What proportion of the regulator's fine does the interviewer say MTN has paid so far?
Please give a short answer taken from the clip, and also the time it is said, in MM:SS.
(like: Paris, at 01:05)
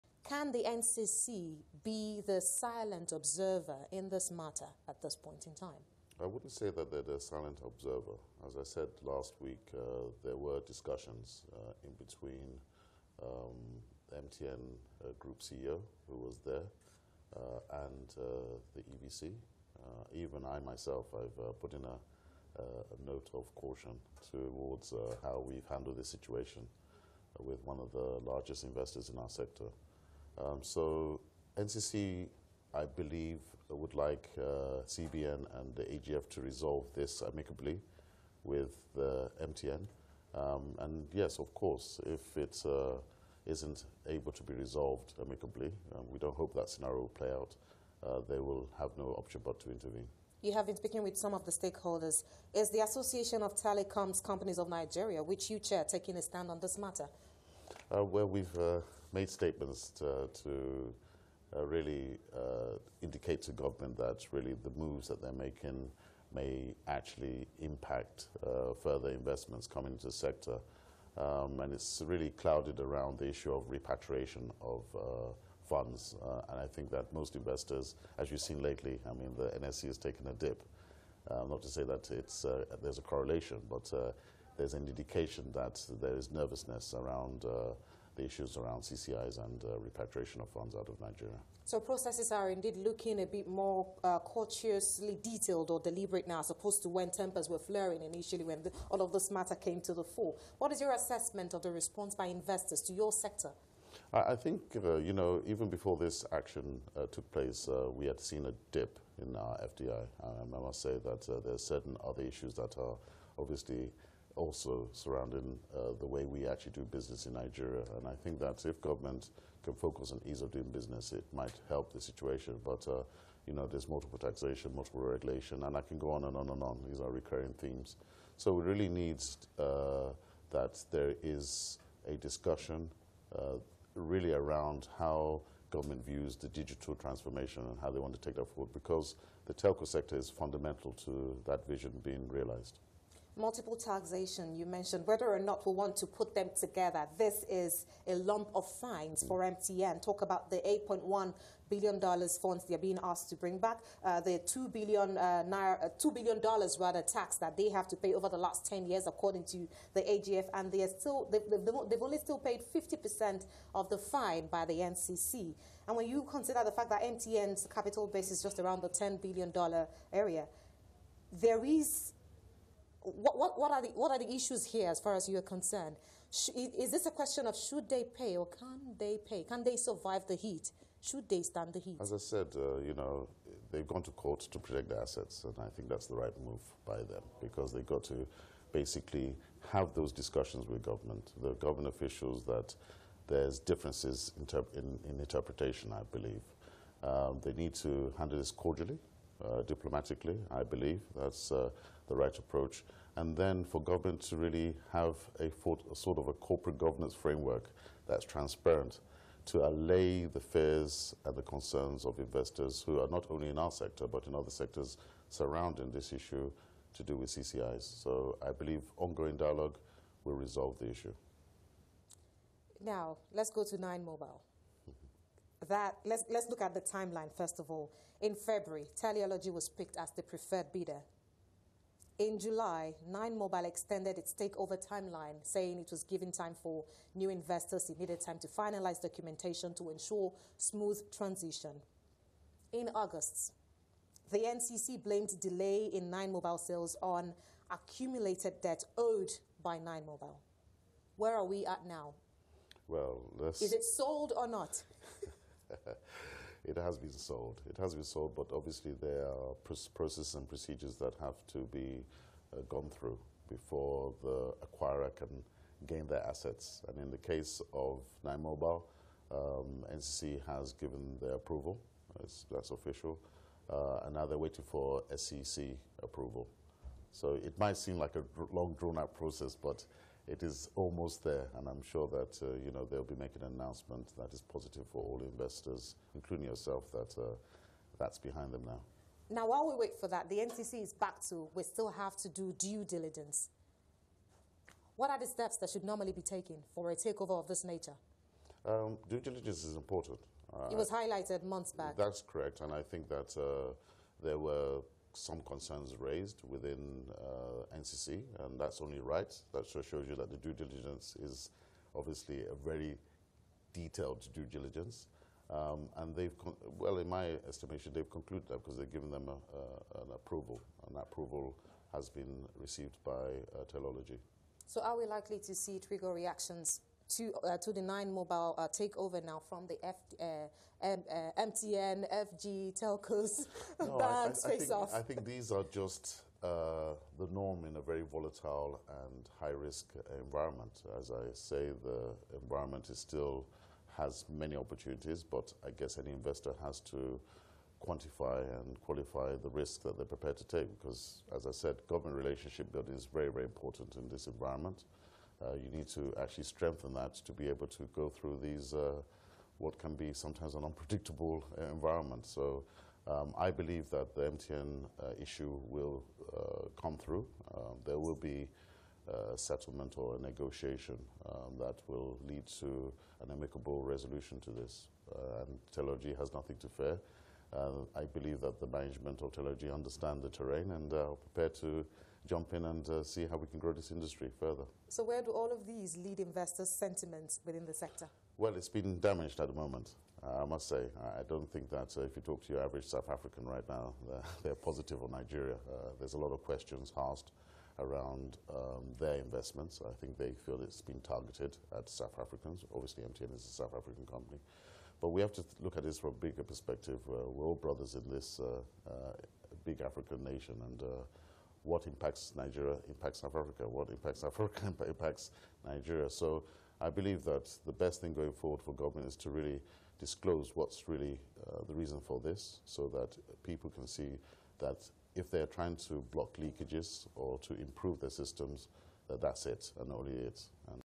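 50%, at 02:42.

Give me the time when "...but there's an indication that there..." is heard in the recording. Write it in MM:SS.
01:23.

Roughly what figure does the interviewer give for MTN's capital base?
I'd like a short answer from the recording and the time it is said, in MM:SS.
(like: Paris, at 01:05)
$10 billion, at 02:48.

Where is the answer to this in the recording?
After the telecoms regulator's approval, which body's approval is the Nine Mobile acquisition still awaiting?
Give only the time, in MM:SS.
04:35.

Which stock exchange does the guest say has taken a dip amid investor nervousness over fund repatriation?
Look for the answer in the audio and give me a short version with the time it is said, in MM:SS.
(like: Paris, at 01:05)
NSE, at 01:19.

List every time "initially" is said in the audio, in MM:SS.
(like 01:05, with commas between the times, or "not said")
01:38.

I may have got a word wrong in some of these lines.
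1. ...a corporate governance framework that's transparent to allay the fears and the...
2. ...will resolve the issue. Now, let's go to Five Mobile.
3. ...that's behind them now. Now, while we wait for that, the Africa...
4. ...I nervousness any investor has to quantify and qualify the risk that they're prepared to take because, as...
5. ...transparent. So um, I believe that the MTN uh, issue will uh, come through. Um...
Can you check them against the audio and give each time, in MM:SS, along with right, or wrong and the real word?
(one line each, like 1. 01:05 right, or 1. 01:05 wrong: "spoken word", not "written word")
1. 03:26 right
2. 03:40 wrong: "Nine", not "Five"
3. 04:47 wrong: "NCC", not "Africa"
4. 05:45 wrong: "guess", not "nervousness"
5. 06:01 wrong: "environment", not "transparent".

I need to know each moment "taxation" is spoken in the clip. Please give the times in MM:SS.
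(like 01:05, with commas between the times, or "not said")
02:04, 02:23.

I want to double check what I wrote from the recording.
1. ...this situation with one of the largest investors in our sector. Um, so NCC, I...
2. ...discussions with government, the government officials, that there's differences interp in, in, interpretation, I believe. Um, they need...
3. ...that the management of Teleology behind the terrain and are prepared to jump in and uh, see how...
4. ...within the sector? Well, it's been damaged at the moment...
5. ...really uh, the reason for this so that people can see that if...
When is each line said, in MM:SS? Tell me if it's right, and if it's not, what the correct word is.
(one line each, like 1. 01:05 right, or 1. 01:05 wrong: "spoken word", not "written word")
1. 00:25 right
2. 03:10 right
3. 06:18 wrong: "understand", not "behind"
4. 06:27 right
5. 07:00 right.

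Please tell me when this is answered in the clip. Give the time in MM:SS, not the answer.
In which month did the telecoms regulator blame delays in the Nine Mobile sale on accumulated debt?
04:02.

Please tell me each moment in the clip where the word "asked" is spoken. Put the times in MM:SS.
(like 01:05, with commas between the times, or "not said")
02:33, 06:36.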